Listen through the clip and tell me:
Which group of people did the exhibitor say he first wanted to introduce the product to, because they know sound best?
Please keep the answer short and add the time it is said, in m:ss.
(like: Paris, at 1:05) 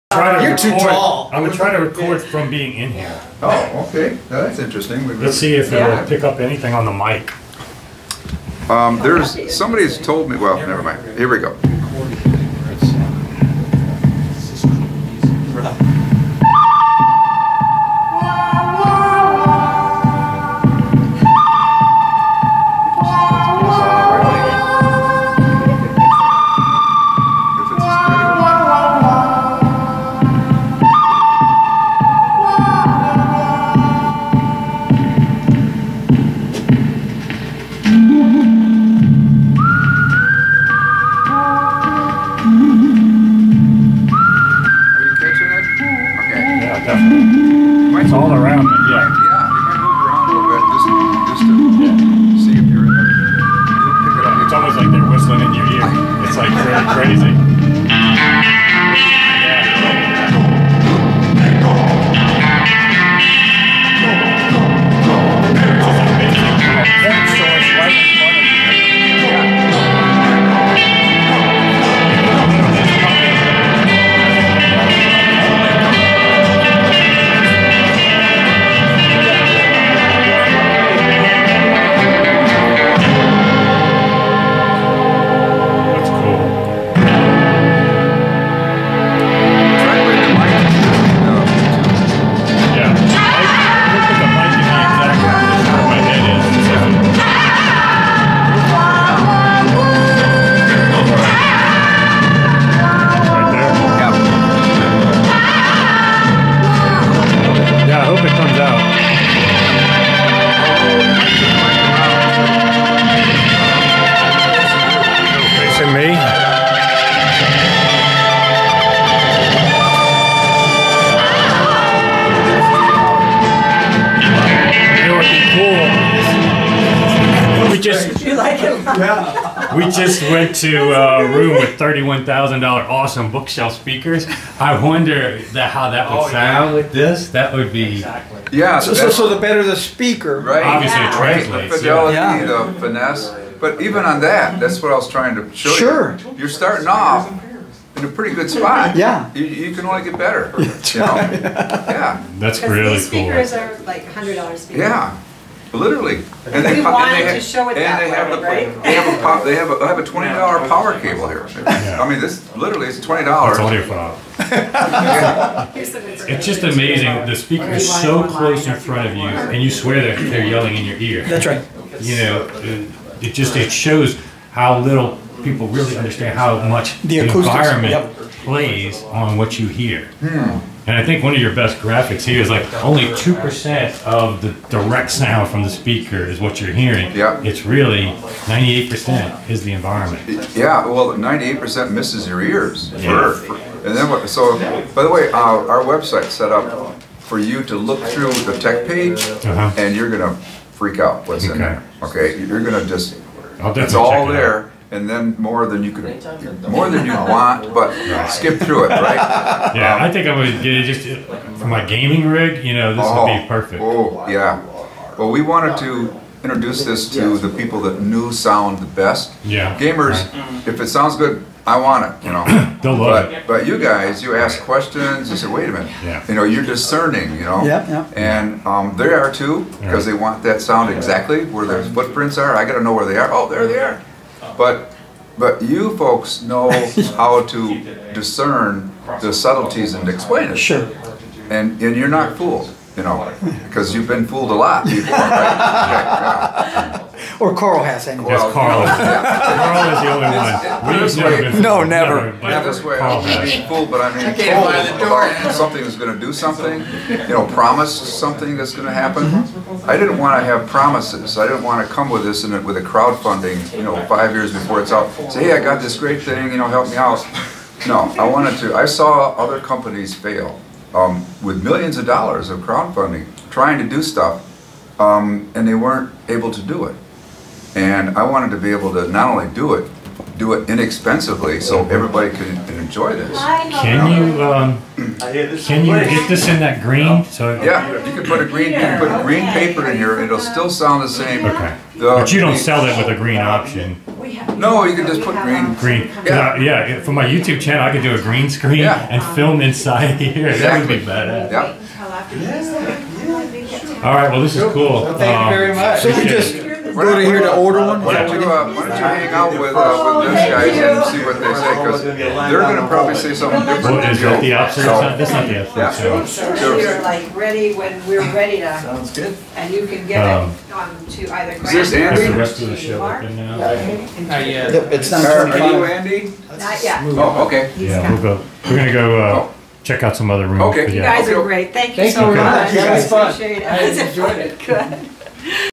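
Gamers, at 3:39.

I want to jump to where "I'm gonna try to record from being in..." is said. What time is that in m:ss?
0:01.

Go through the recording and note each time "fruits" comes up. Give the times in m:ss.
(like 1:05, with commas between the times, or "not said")
not said.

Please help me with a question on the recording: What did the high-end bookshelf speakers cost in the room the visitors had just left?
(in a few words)
$31,000.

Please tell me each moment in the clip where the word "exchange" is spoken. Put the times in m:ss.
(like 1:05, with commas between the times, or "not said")
not said.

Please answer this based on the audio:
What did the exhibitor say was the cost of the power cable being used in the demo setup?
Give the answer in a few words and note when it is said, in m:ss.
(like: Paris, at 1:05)
$20, at 2:40.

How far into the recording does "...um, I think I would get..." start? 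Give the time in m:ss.
3:29.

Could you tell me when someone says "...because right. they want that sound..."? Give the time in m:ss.
3:49.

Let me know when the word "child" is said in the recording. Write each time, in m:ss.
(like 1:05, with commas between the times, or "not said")
not said.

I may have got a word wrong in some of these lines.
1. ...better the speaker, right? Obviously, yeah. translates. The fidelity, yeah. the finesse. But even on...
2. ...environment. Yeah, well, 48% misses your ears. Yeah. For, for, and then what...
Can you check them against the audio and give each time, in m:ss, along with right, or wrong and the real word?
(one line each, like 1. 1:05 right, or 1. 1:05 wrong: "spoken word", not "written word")
1. 2:19 right
2. 3:09 wrong: "98", not "48".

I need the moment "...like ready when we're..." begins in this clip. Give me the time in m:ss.
5:17.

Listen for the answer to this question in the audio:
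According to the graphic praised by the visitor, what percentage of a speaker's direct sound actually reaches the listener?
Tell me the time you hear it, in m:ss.
3:03.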